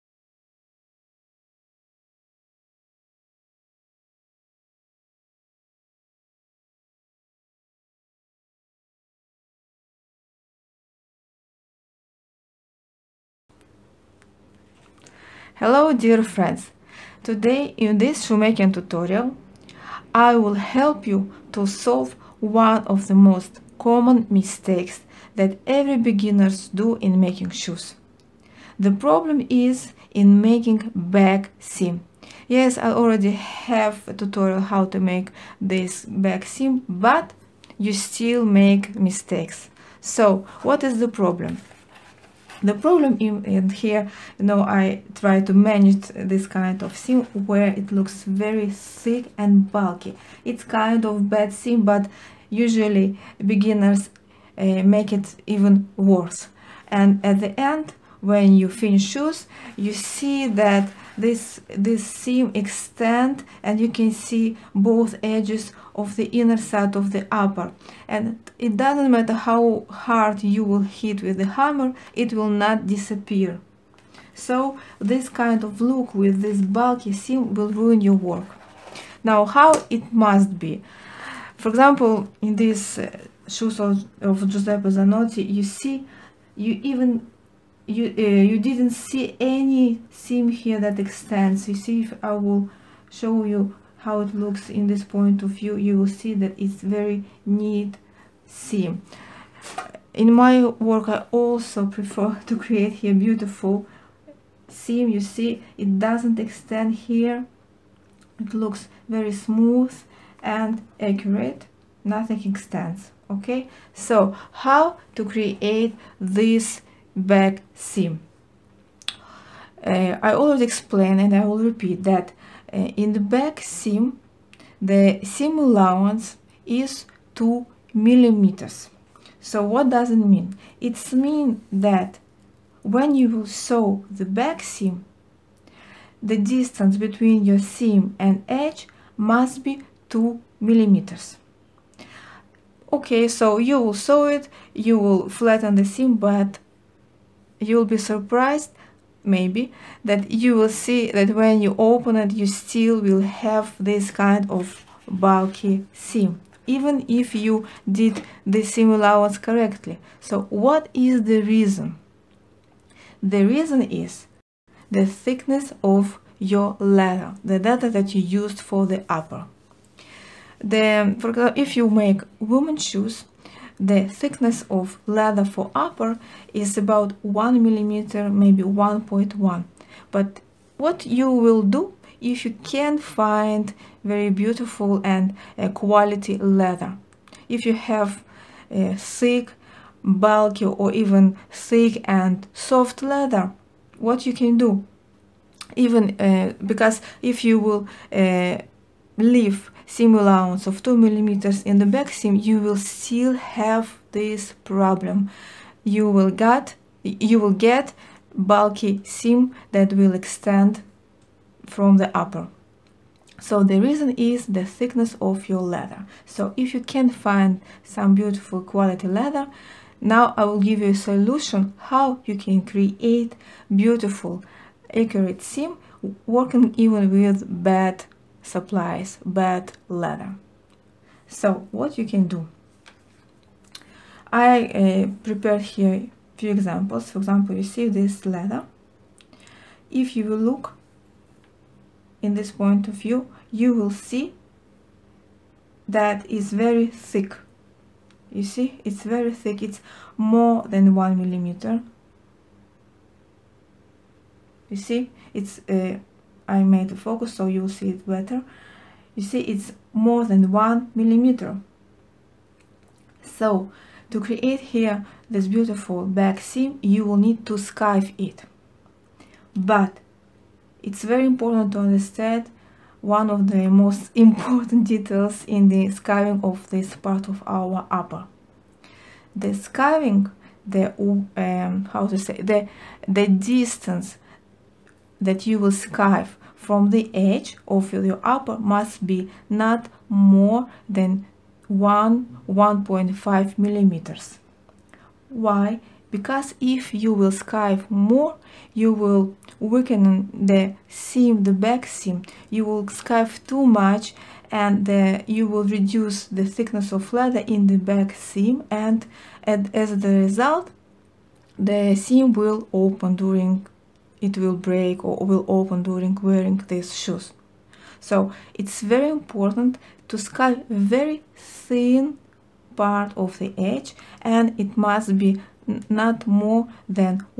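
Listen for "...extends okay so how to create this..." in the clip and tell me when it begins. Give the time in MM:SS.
01:52.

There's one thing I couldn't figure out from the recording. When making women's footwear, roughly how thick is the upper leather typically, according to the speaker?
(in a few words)
1 millimeter.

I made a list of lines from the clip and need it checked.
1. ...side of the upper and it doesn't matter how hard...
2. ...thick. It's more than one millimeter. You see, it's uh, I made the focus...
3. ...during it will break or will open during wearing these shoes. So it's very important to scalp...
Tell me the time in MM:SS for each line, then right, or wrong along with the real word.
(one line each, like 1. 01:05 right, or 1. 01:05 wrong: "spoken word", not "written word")
1. 01:06 right
2. 04:09 right
3. 05:13 right.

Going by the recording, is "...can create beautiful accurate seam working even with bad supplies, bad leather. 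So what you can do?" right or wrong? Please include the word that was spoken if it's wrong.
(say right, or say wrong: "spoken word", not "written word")
right.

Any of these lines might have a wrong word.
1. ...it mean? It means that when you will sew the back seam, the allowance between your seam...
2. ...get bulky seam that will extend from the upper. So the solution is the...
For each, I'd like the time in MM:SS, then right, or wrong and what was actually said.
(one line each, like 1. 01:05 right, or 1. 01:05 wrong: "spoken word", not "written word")
1. 02:10 wrong: "distance", not "allowance"
2. 03:27 wrong: "reason", not "solution".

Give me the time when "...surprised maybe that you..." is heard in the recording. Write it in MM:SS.
02:27.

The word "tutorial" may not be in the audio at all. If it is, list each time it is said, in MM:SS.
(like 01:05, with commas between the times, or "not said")
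00:18, 00:34.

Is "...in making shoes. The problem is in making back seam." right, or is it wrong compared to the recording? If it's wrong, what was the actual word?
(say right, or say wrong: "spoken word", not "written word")
right.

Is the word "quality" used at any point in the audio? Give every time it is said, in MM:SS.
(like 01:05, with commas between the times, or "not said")
03:05, 03:38.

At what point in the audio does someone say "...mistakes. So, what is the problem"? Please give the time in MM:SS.
00:38.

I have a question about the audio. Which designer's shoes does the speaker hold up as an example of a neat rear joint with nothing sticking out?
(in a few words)
Giuseppe Zanotti.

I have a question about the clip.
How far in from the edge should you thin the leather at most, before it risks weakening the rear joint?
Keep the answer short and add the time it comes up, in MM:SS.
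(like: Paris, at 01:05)
1.5 millimeters, at 04:52.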